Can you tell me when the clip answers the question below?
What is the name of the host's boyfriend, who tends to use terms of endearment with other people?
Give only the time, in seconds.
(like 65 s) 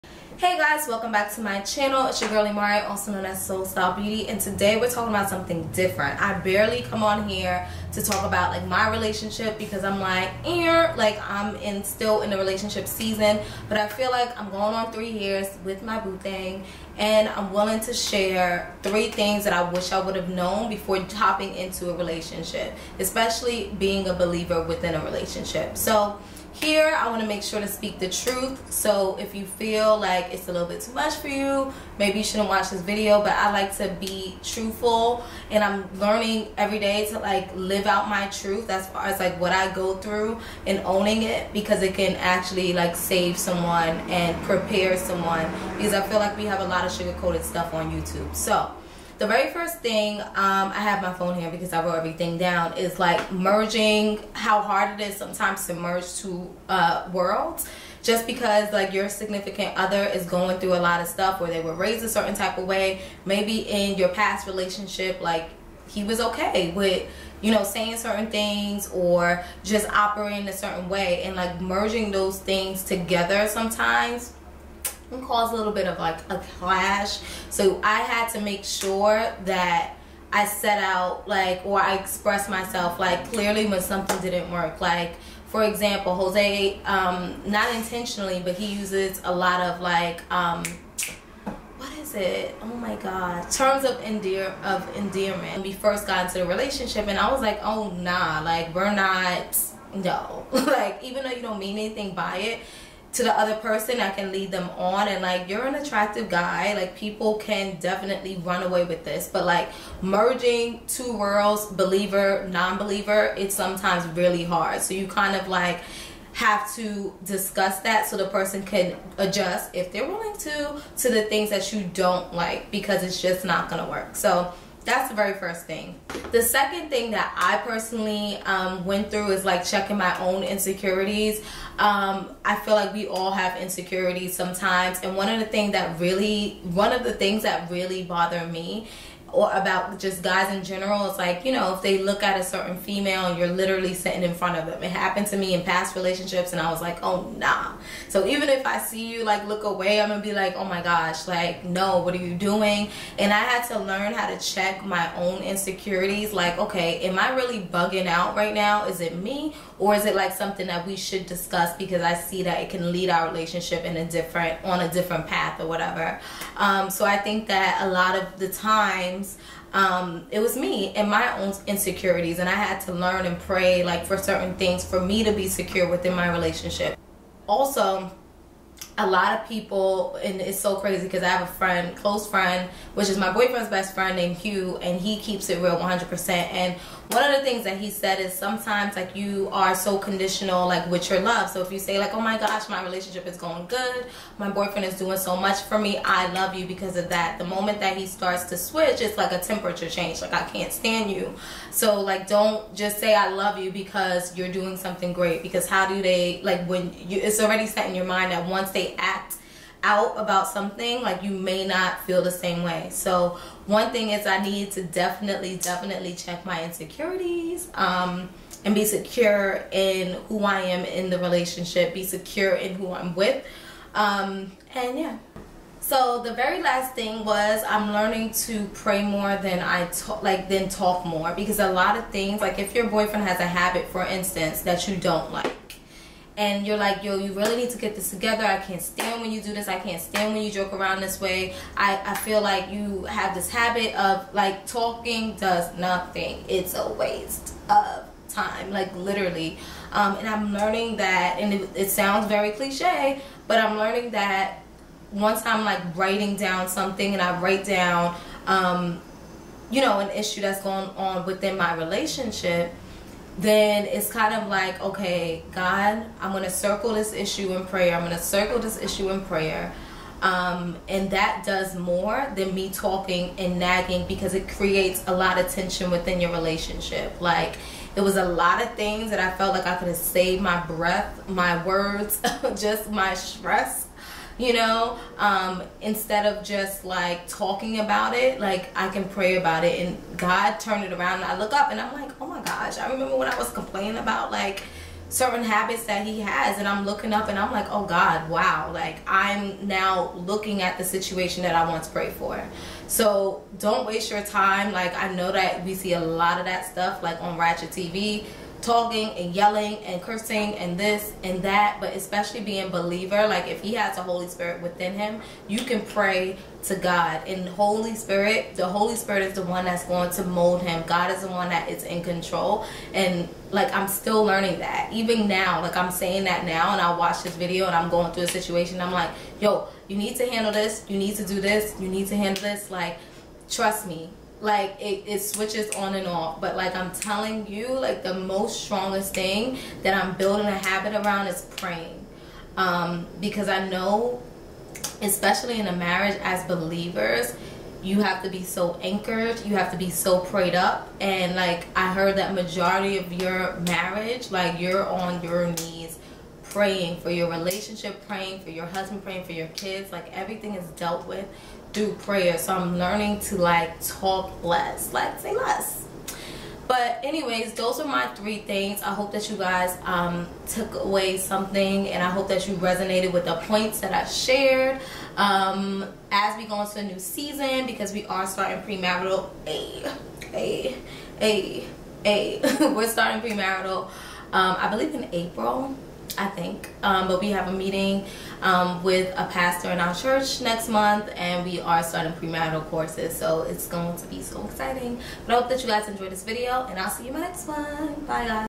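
86 s.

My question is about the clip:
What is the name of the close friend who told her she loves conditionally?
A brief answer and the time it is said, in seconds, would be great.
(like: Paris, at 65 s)
Hugh, at 184 s.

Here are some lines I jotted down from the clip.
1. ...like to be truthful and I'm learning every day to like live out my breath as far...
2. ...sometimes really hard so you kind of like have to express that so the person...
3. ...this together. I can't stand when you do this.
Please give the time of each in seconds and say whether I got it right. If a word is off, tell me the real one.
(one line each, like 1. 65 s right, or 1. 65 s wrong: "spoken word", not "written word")
1. 33 s wrong: "truth", not "breath"
2. 113 s wrong: "discuss", not "express"
3. 237 s right.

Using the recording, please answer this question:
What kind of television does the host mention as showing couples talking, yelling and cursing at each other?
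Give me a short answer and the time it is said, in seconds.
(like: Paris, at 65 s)
Ratchet TV, at 307 s.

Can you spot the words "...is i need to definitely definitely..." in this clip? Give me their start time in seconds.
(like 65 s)
214 s.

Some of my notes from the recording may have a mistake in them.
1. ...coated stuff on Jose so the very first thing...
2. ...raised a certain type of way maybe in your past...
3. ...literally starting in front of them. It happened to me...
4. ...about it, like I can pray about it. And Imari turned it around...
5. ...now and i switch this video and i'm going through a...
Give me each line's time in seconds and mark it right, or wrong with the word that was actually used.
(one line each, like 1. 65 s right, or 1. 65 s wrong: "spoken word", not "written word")
1. 47 s wrong: "YouTube", not "Jose"
2. 61 s right
3. 143 s wrong: "sitting", not "starting"
4. 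287 s wrong: "God", not "Imari"
5. 326 s wrong: "watch", not "switch".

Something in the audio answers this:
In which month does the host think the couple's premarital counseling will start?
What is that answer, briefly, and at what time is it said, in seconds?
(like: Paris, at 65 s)
April, at 385 s.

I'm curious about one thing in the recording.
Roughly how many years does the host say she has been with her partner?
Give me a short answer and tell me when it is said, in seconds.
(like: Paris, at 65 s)
3 years, at 14 s.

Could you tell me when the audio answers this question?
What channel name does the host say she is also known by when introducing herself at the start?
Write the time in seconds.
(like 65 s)
3 s.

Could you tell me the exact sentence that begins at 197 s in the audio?
The moment that he starts to switch, it's like a temperature change.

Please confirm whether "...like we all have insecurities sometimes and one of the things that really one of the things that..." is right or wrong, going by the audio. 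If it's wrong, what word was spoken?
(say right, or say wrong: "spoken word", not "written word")
right.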